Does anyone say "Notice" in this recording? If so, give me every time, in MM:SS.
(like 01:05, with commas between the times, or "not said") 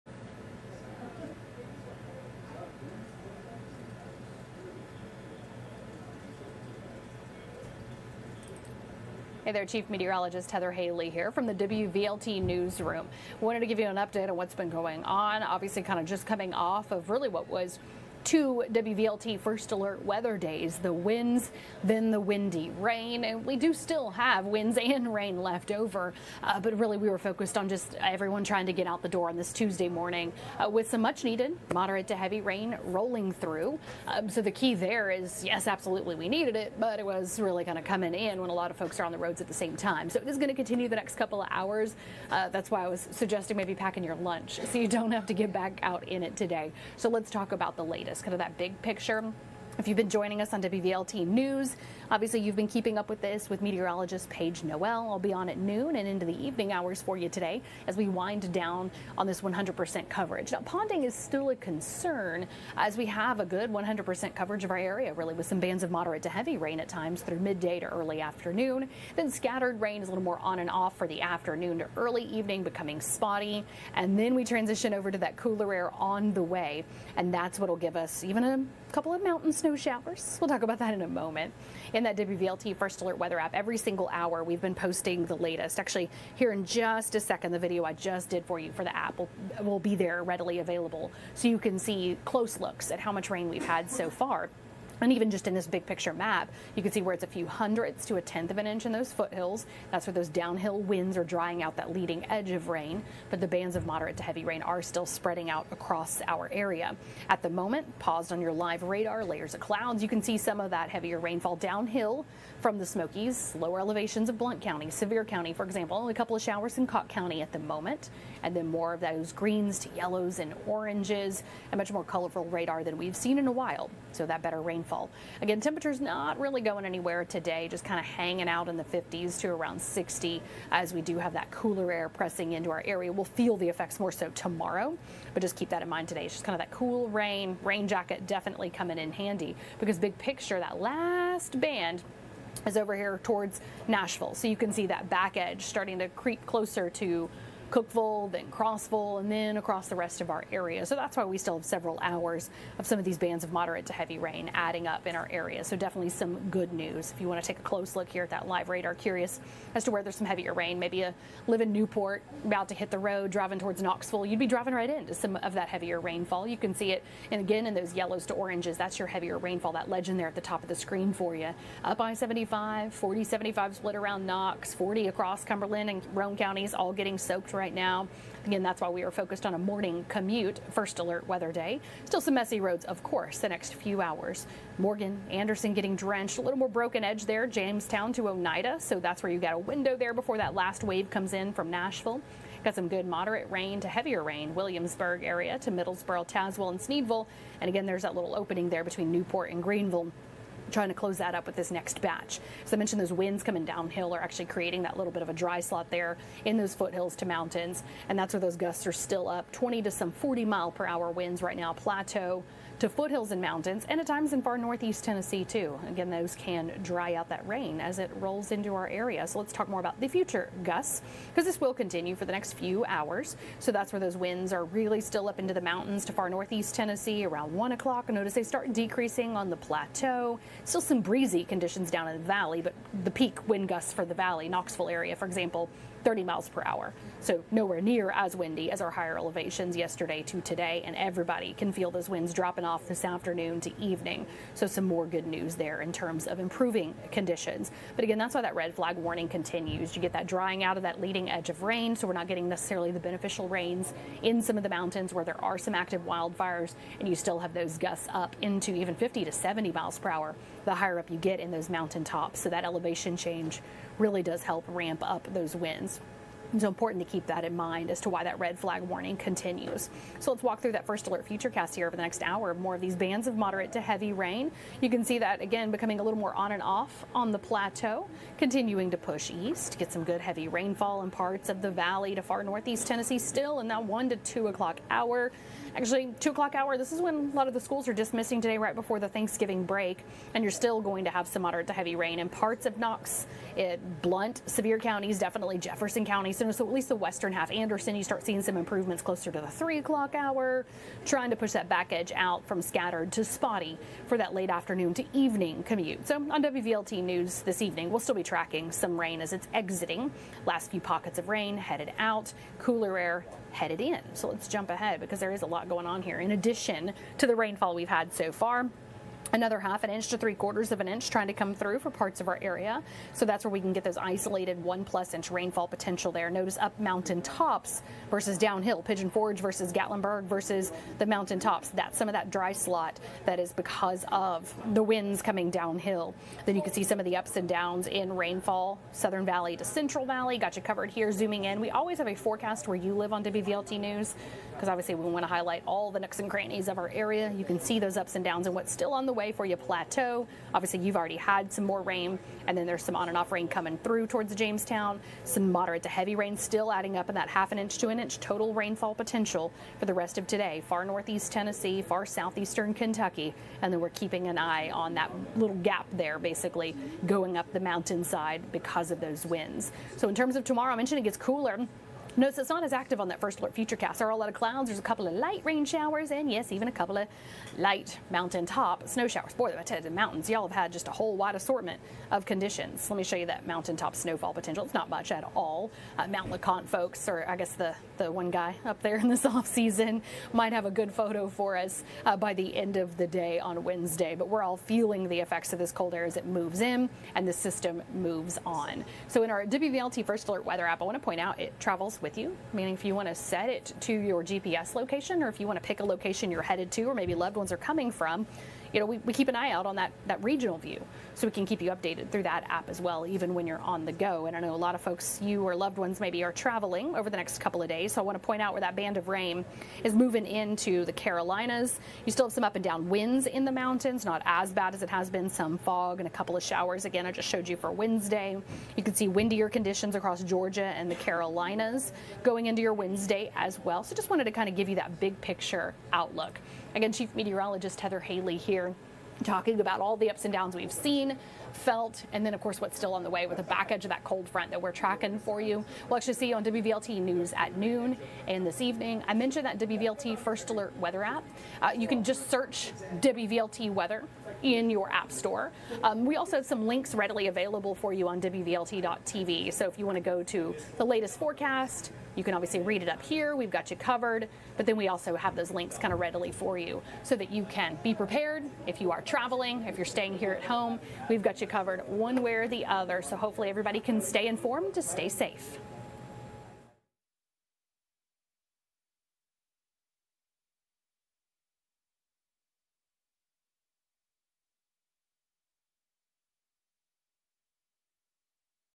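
03:48, 05:26, 06:12.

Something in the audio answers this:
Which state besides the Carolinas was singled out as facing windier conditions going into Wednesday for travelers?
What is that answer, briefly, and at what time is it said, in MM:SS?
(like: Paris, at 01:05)
Georgia, at 07:10.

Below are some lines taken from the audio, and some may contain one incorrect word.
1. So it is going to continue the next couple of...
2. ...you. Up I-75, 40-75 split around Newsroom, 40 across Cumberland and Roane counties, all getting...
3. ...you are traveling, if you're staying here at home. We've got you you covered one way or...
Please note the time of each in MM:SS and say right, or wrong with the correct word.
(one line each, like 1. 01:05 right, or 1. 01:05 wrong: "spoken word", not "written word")
1. 00:40 right
2. 02:51 wrong: "Knox", not "Newsroom"
3. 07:48 right.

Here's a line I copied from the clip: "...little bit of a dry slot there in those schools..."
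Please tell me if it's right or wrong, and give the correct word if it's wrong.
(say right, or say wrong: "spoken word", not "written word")
wrong: "foothills", not "schools".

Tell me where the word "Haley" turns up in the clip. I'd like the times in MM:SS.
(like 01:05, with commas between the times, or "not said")
00:10, 07:17.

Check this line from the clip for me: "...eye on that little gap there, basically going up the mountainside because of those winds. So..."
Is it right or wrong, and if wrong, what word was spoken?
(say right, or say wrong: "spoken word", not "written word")
right.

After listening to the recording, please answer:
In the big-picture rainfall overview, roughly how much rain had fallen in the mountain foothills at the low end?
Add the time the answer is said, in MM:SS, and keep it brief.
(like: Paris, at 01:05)
a few hundredths, at 01:37.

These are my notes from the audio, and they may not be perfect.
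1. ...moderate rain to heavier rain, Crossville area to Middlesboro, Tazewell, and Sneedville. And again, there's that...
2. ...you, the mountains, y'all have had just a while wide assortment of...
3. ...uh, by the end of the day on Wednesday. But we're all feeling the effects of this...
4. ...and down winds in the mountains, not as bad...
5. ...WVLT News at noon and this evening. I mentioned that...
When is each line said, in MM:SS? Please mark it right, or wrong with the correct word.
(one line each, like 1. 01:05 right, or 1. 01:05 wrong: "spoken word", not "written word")
1. 03:13 wrong: "Williamsburg", not "Crossville"
2. 06:19 wrong: "whole", not "while"
3. 06:32 right
4. 07:02 right
5. 07:26 right.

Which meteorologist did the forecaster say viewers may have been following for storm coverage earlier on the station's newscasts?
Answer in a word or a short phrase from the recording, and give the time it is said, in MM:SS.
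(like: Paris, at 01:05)
Paige Noel, at 00:54.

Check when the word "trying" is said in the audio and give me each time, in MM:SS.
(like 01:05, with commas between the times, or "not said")
00:28, 03:20, 05:01, 05:21.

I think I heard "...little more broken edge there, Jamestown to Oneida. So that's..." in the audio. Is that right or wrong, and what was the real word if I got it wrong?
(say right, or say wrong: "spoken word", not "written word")
right.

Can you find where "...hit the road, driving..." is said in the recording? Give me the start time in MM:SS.
02:42.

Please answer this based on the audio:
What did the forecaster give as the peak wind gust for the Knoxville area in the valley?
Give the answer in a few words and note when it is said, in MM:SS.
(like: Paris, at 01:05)
30 miles per hour, at 03:56.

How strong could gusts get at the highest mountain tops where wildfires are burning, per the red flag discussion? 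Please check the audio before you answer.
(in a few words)
50 to 70 miles per hour.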